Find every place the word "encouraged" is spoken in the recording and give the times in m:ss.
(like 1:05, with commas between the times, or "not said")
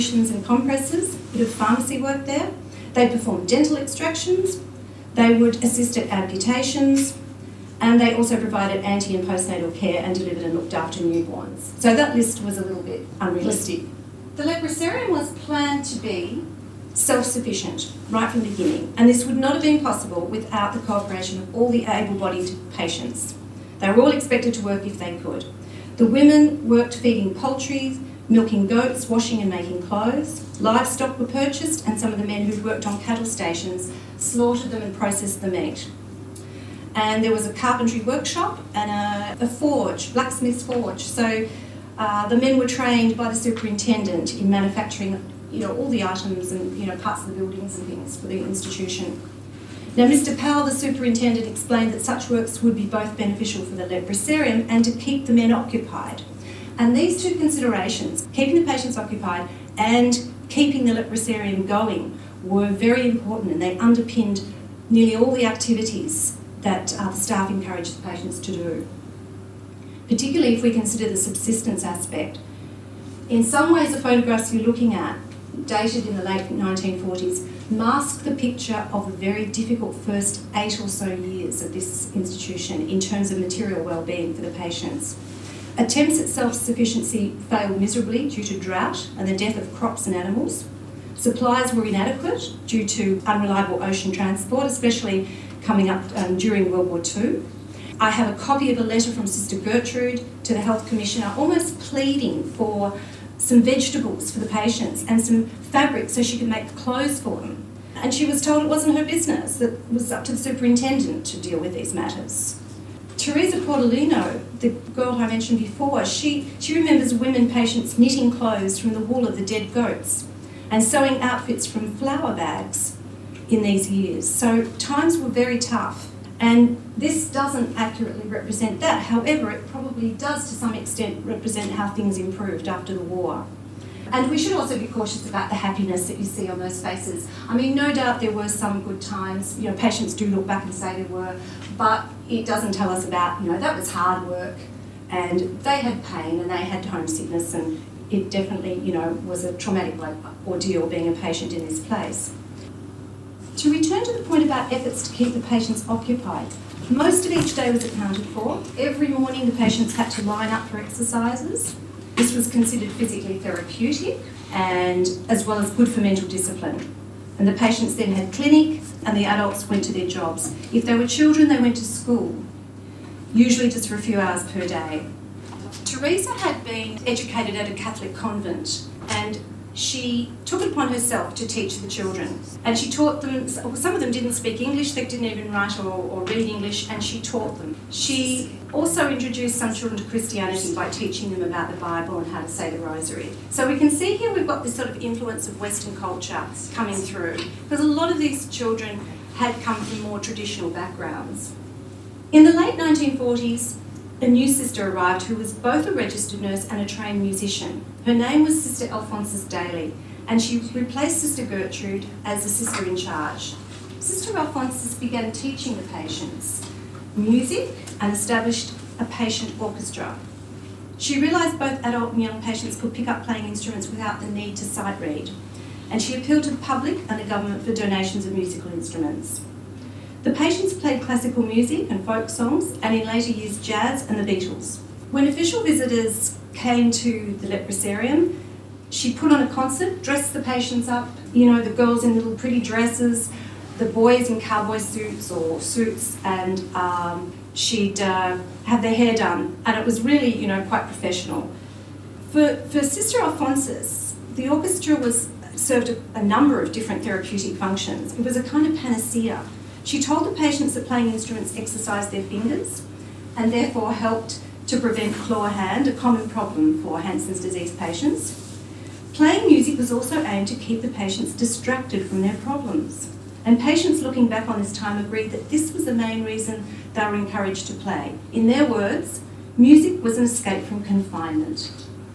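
1:07, 4:37.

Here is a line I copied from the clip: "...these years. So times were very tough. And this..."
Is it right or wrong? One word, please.
right.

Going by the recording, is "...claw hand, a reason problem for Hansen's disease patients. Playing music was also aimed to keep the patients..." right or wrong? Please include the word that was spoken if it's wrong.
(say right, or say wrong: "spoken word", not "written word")
wrong: "common", not "reason".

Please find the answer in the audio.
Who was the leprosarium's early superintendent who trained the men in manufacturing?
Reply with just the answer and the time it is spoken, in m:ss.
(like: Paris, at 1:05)
Mr. Powell, at 0:50.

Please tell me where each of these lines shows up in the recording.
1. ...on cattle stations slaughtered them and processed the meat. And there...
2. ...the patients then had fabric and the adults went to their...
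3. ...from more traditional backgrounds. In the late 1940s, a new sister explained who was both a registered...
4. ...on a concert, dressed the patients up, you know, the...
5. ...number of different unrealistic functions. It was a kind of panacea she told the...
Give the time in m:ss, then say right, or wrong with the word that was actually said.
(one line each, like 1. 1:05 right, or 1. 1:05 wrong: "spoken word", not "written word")
1. 0:32 right
2. 2:47 wrong: "clinic", not "fabric"
3. 3:19 wrong: "arrived", not "explained"
4. 3:59 right
5. 4:16 wrong: "therapeutic", not "unrealistic".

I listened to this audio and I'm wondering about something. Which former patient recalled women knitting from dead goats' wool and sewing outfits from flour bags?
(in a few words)
Teresa Portolino.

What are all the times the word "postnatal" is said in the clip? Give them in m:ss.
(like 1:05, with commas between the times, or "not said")
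0:09.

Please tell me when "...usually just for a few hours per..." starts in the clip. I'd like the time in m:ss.
2:53.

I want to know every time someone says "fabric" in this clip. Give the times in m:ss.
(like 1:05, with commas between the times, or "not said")
1:45.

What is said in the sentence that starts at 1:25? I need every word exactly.
Attempts at self-sufficiency failed miserably due to drought and the death of crops and animals.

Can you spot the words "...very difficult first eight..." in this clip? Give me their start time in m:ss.
1:19.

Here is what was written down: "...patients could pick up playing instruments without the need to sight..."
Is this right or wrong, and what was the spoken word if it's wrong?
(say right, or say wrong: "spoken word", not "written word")
right.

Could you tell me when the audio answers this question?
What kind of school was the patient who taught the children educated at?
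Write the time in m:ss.
2:57.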